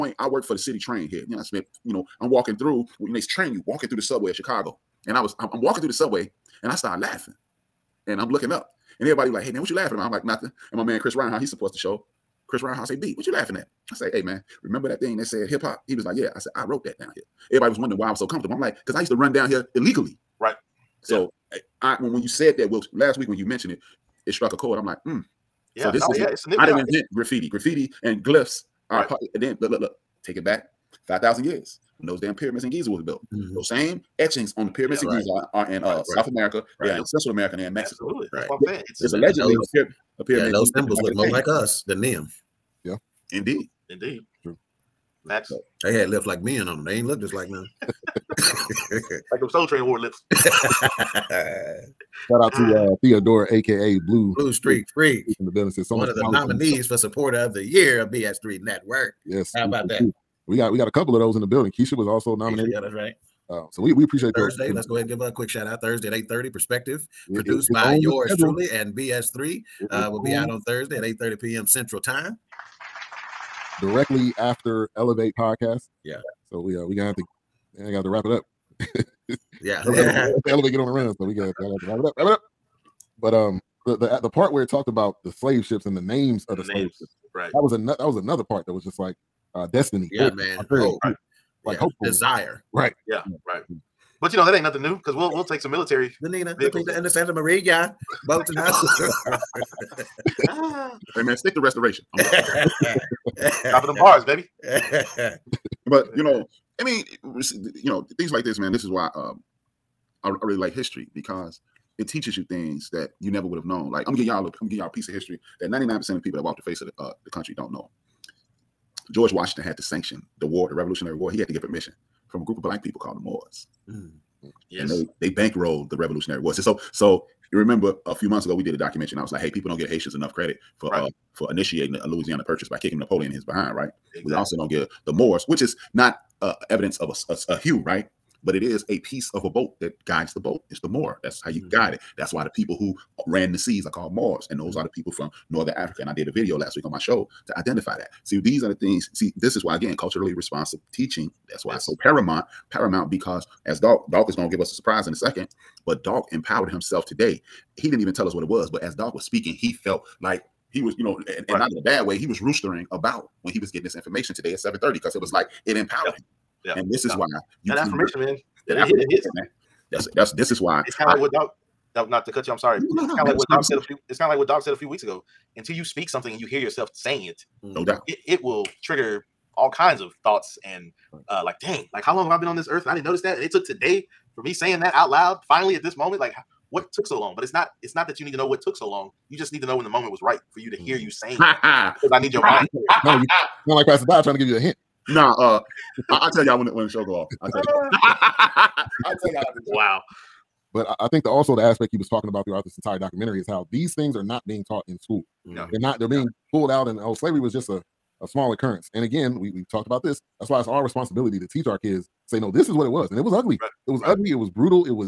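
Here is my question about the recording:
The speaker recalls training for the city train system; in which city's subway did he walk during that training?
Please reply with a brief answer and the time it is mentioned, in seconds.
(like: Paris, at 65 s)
Chicago, at 4 s.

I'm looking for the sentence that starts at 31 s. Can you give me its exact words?
When those damn pyramids in Giza was built.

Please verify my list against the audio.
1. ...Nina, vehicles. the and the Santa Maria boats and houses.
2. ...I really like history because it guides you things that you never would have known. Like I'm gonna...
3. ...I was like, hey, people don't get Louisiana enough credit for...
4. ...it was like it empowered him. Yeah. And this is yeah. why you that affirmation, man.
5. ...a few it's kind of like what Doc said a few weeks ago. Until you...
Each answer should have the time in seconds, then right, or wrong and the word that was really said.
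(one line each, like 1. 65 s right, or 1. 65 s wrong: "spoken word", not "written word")
1. 96 s right
2. 110 s wrong: "teaches", not "guides"
3. 129 s wrong: "Haitians", not "Louisiana"
4. 165 s right
5. 173 s right.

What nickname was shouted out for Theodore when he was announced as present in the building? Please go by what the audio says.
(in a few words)
Blue Street Freak.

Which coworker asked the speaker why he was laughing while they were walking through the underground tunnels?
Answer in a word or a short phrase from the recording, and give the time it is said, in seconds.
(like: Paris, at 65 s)
Chris Reinhart, at 12 s.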